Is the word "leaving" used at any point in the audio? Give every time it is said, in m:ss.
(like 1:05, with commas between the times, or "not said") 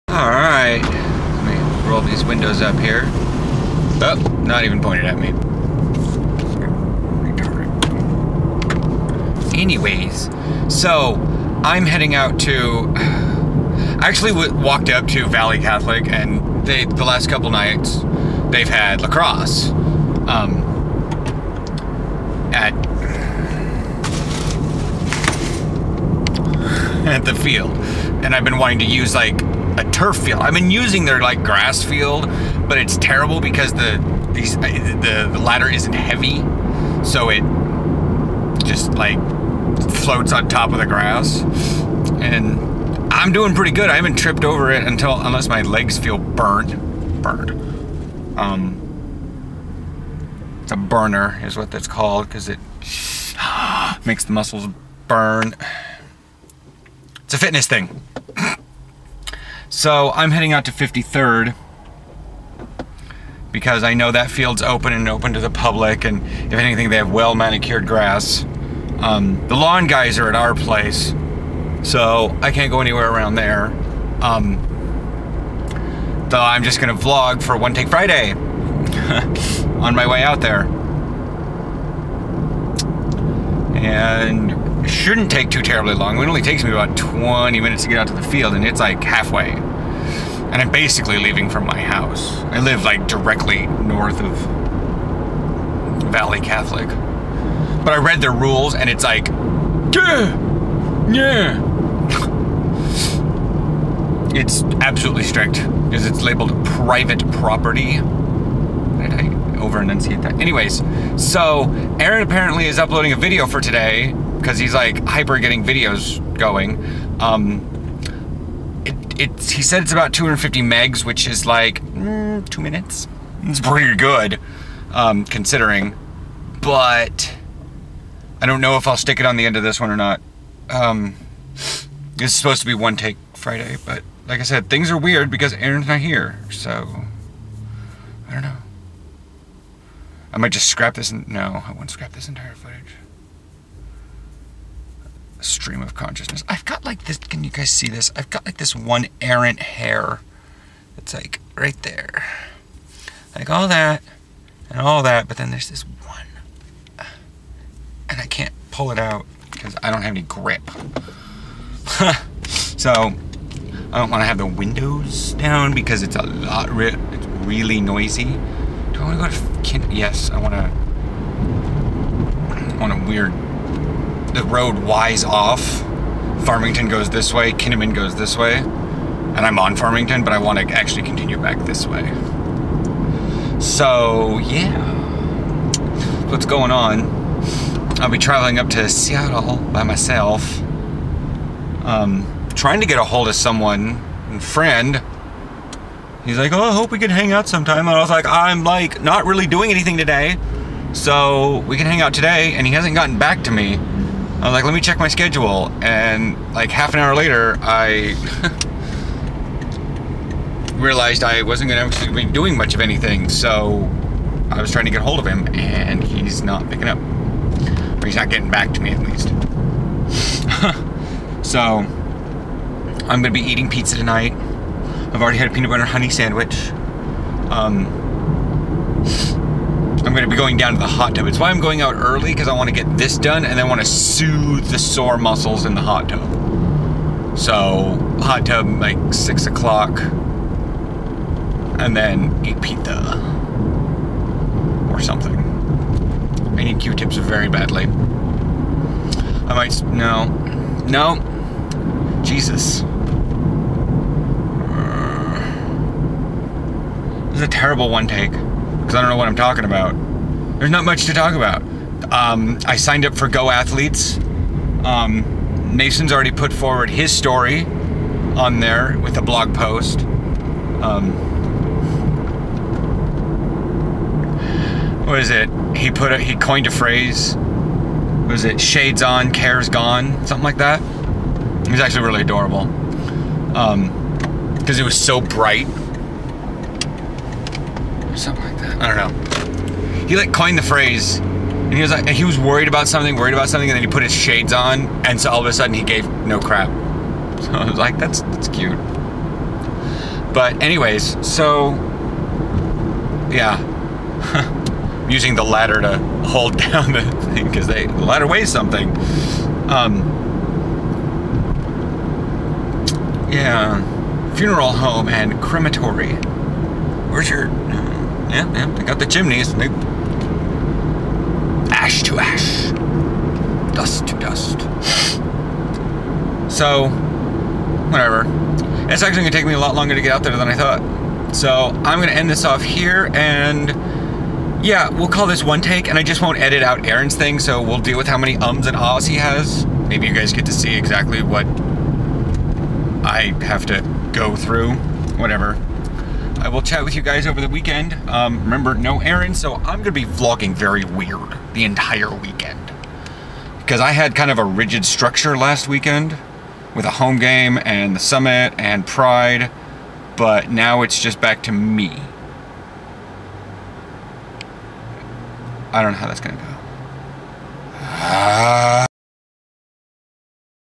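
1:31.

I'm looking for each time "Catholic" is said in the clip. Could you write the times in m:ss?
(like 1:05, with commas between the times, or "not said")
0:15, 1:36.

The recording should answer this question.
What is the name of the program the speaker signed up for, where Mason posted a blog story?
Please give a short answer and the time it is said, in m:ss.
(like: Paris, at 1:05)
Go Athletes, at 4:23.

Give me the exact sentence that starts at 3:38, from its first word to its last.
Or he's not getting back to me, at least.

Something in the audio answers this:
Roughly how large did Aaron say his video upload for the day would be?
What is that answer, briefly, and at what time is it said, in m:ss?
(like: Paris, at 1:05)
250 megs, at 2:00.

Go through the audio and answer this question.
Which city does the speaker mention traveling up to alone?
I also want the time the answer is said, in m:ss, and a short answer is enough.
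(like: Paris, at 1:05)
Seattle, at 3:08.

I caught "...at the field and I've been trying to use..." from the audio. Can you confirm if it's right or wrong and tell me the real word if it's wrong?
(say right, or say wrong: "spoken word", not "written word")
wrong: "wanting", not "trying".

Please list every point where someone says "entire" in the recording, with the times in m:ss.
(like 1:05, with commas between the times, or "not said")
2:22, 5:51.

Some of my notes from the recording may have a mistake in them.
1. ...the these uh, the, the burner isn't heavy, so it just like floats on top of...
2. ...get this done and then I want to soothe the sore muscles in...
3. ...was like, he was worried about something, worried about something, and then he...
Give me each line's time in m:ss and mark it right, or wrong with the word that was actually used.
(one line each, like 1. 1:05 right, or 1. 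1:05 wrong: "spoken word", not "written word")
1. 0:33 wrong: "ladder", not "burner"
2. 3:52 right
3. 4:51 right.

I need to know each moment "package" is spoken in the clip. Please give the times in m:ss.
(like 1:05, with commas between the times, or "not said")
not said.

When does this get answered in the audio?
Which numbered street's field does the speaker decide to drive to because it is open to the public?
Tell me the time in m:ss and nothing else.
1:00.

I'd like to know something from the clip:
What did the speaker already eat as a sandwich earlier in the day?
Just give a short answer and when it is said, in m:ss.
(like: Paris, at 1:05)
peanut butter honey, at 3:45.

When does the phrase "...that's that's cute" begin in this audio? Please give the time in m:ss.
4:57.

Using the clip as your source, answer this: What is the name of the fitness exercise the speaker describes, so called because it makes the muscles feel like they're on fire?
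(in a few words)
a burner.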